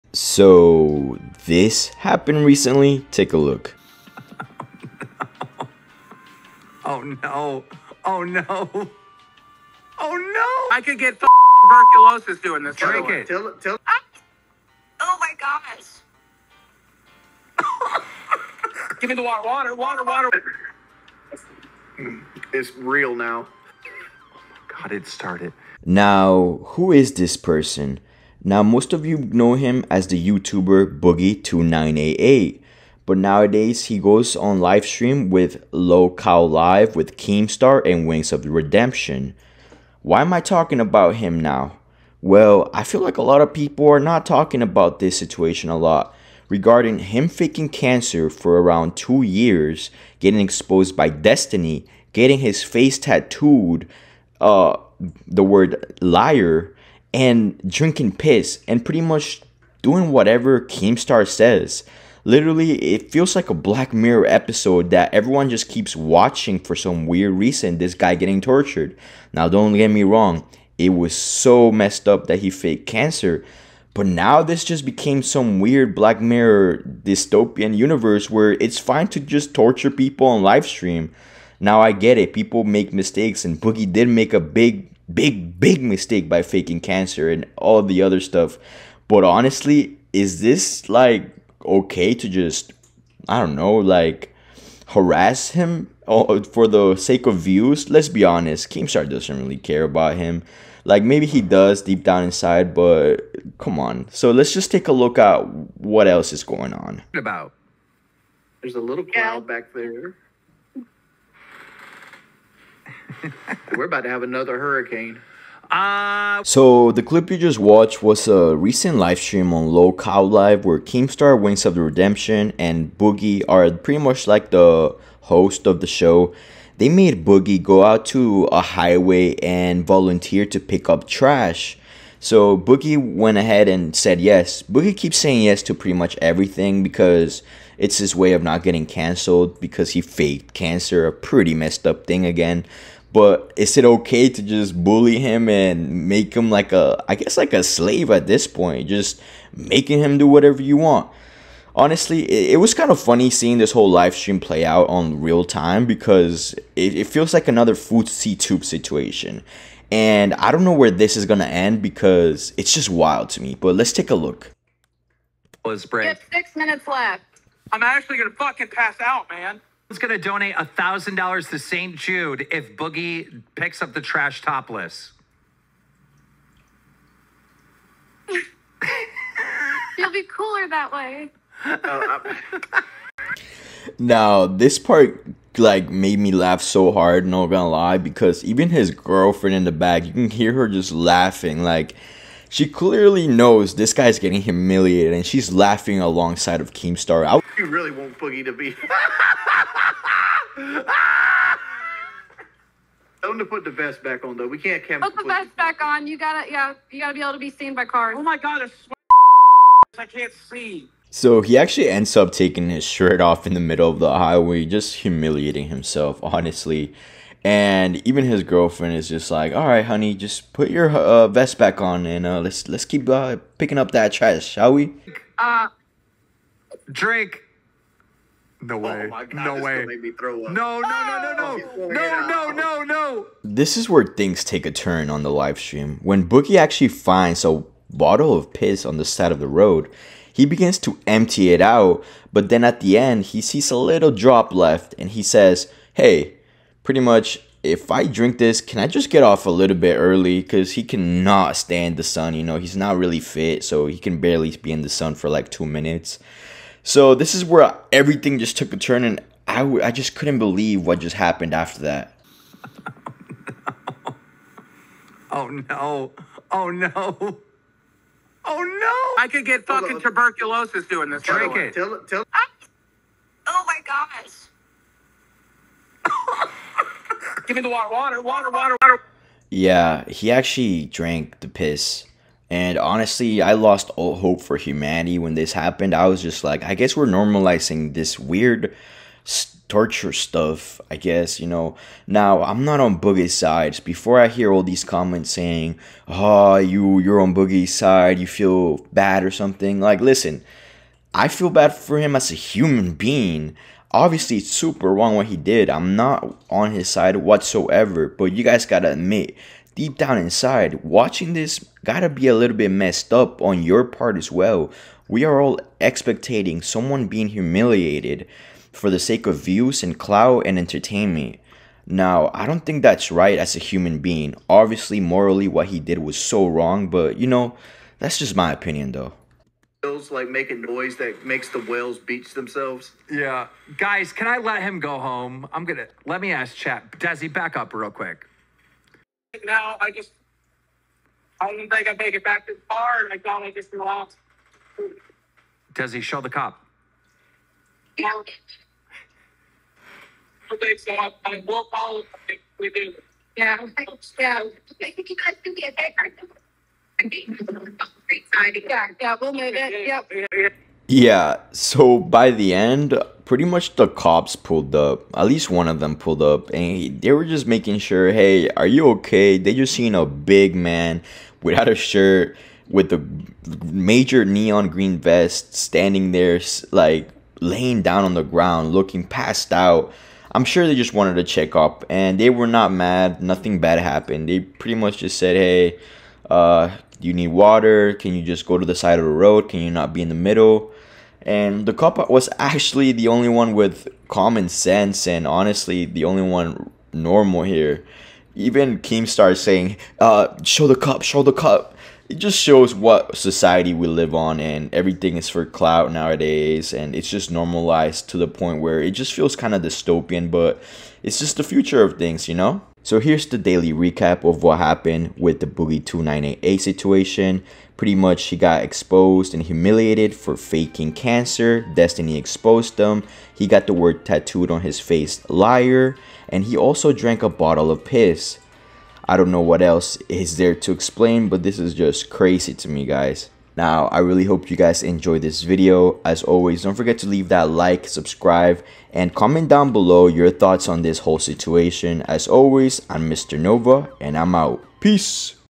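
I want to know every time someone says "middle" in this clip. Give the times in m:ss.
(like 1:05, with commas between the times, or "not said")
3:33, 6:30.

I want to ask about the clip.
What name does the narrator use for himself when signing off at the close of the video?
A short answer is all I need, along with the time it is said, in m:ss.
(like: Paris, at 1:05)
Mr. Nova, at 7:23.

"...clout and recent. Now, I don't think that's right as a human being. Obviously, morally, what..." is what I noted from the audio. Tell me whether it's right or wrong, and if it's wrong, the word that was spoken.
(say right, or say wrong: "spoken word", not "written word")
wrong: "entertainment", not "recent".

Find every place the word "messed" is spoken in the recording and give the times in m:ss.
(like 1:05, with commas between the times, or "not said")
1:11, 2:21, 5:12.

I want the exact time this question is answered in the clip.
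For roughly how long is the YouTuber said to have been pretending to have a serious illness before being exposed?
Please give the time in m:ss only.
0:48.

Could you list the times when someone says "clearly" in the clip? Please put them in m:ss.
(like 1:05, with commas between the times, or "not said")
3:12.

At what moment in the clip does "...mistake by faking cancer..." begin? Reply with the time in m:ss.
1:25.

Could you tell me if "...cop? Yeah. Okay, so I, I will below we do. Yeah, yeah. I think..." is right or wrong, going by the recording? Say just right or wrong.
wrong.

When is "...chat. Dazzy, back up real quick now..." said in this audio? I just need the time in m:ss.
5:36.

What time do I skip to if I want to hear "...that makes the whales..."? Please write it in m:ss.
5:30.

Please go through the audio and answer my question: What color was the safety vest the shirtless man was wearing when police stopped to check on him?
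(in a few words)
neon green.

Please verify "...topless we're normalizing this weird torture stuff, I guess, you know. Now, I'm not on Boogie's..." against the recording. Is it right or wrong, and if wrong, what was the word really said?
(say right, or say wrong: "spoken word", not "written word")
wrong: "guess", not "topless".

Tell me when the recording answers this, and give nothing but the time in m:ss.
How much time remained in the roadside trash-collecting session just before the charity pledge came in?
2:46.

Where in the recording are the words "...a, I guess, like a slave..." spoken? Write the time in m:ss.
2:26.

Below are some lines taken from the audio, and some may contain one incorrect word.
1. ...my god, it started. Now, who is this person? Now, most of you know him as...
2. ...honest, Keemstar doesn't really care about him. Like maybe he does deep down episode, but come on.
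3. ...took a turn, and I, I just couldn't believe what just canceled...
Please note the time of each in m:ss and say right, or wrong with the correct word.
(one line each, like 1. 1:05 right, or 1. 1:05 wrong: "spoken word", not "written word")
1. 0:24 right
2. 1:38 wrong: "inside", not "episode"
3. 4:18 wrong: "happened", not "canceled".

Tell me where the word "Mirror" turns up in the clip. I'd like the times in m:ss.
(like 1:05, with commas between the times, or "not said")
1:03, 1:16.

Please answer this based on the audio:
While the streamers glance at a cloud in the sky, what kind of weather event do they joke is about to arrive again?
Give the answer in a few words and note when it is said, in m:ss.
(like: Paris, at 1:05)
hurricane, at 1:54.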